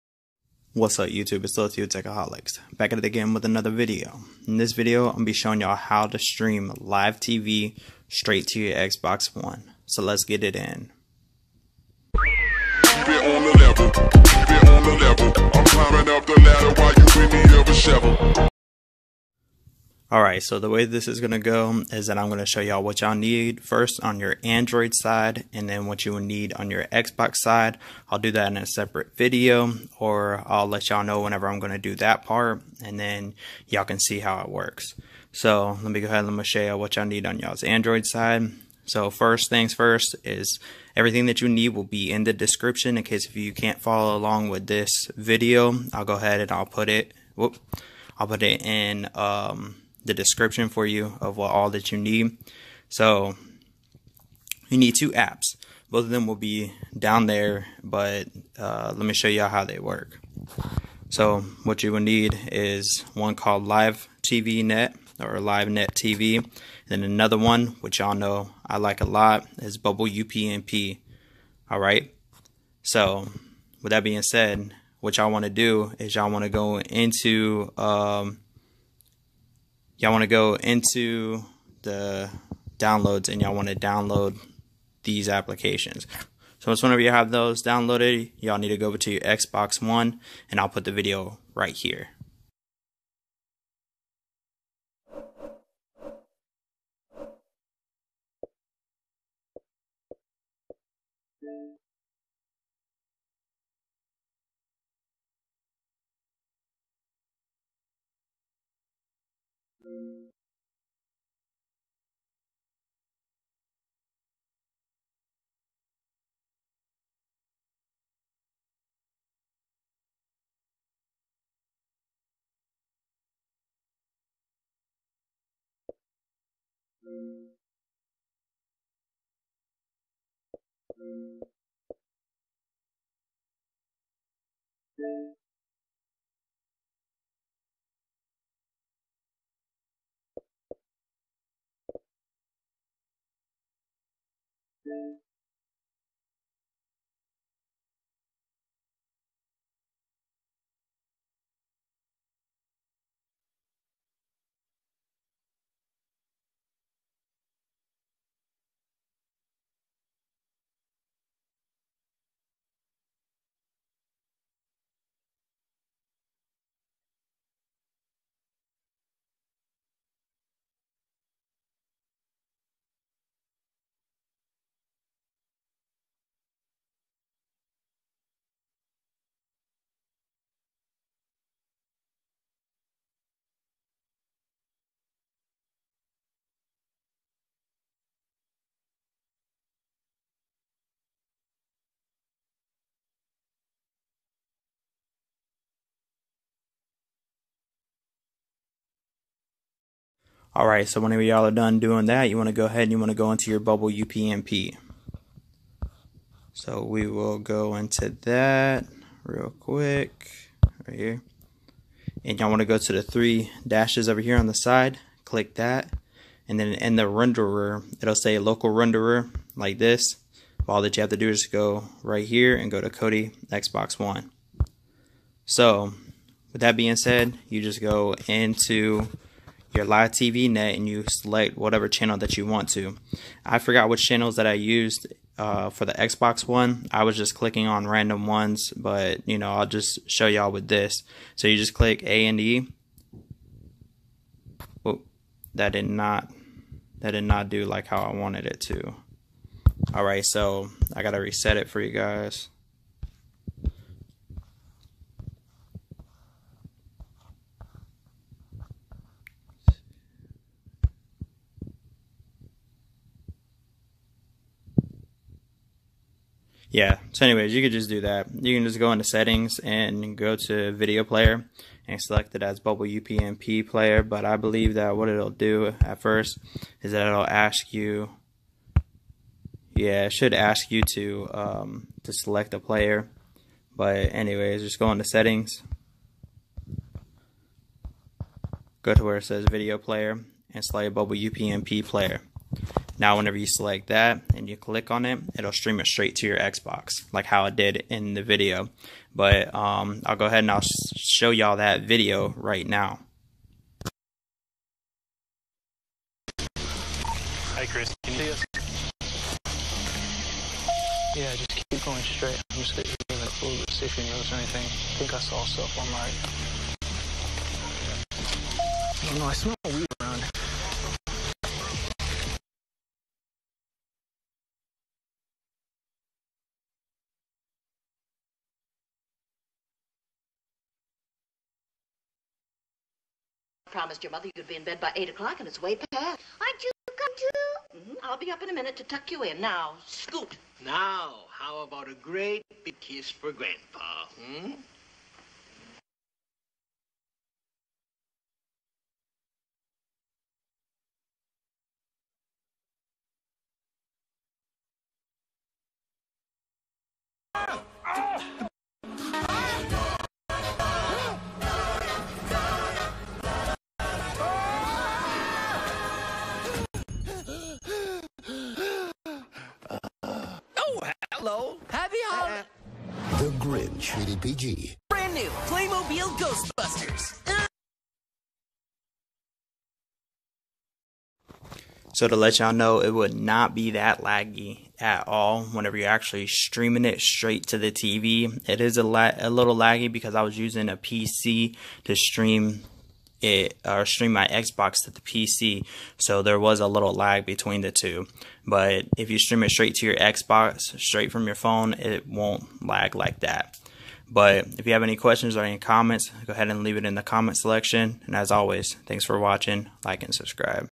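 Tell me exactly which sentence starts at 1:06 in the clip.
And then another one, which y'all know I like a lot, is Bubble UPnP.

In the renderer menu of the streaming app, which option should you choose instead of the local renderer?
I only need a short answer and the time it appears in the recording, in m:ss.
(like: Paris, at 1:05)
Kodi Xbox One, at 3:42.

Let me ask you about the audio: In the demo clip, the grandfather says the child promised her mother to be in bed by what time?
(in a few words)
8 o'clock.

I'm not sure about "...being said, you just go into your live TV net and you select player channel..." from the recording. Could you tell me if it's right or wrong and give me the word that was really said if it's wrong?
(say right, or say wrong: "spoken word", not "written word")
wrong: "whatever", not "player".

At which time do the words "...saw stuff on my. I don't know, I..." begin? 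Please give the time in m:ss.
5:15.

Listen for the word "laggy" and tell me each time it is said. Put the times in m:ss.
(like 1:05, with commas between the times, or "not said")
6:24, 6:29.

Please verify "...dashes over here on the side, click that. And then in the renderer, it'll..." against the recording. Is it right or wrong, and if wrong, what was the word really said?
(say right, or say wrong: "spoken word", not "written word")
right.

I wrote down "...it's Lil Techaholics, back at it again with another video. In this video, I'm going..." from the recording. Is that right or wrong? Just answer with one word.
right.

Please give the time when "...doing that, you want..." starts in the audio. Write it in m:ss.
3:21.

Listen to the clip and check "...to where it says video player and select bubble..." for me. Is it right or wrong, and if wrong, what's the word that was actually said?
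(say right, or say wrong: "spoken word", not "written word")
right.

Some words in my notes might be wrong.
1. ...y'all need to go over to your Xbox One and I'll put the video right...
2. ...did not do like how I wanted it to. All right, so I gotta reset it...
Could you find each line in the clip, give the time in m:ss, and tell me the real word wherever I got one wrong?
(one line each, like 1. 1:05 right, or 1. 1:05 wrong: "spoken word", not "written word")
1. 1:28 right
2. 4:07 right.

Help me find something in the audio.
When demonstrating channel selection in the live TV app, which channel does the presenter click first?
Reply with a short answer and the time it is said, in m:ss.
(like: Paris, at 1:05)
A and E, at 4:02.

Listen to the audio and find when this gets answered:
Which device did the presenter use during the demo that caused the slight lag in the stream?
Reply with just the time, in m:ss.
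6:30.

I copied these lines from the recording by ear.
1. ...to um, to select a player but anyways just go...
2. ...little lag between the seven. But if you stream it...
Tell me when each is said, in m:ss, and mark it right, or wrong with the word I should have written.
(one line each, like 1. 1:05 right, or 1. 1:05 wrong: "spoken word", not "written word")
1. 4:40 right
2. 6:36 wrong: "two", not "seven".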